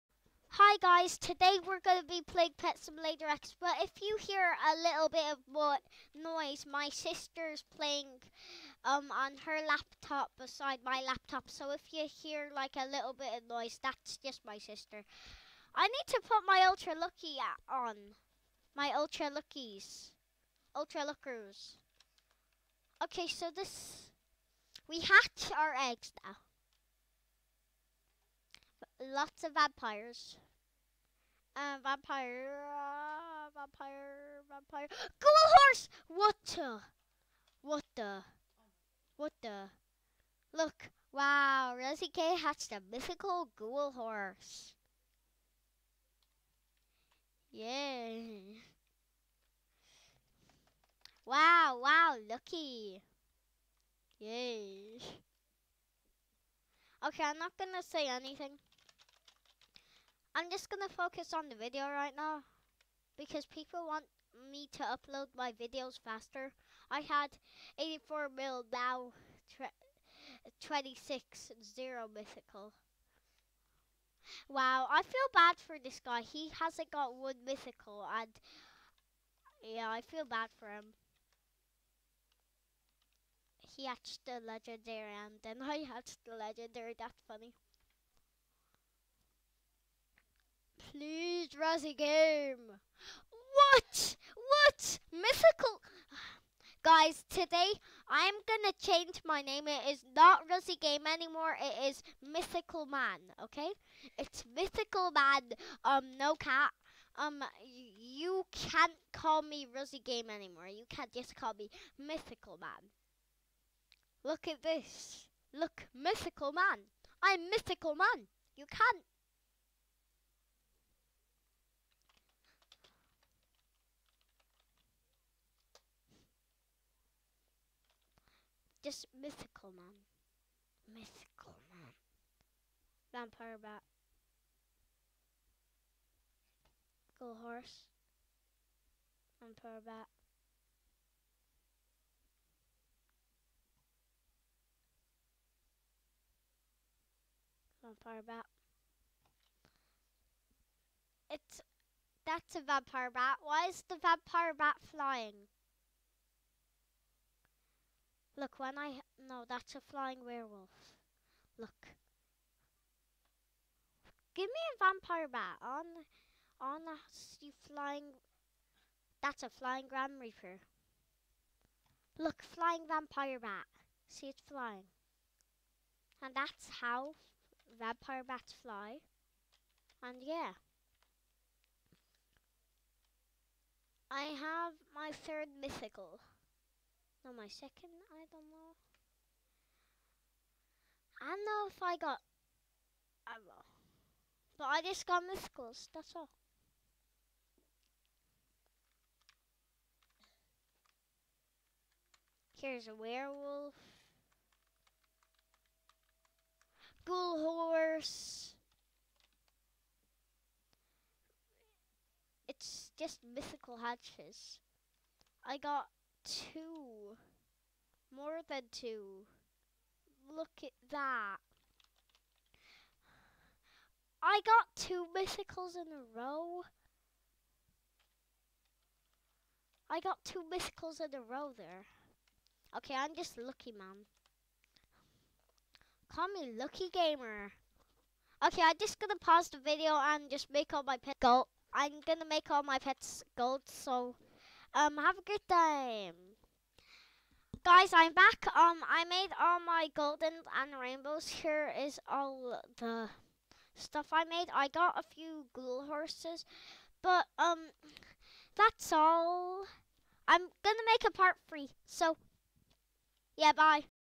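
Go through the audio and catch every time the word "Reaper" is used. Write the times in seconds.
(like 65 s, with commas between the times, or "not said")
170 s.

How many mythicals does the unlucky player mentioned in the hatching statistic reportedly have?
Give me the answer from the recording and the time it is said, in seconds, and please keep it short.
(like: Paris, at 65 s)
0, at 71 s.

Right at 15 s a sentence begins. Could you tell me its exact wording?
I need to put my Ultra Lucky on.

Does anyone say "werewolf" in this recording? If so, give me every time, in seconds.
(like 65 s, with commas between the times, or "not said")
160 s, 202 s.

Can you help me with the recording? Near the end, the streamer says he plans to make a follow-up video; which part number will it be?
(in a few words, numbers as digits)
3.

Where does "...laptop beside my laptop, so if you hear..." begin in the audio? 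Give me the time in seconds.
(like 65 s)
9 s.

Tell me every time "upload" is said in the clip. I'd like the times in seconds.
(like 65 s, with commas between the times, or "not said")
64 s.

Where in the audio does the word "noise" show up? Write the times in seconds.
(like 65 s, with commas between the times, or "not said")
6 s, 13 s.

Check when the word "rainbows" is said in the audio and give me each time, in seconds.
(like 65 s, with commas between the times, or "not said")
250 s.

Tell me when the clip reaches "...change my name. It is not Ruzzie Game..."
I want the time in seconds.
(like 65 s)
98 s.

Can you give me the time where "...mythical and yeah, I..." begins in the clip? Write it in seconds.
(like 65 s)
77 s.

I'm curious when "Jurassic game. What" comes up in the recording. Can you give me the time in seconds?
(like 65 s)
91 s.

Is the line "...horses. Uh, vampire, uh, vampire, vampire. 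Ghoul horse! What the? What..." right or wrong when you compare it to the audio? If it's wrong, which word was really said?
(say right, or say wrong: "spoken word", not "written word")
wrong: "vampires", not "horses".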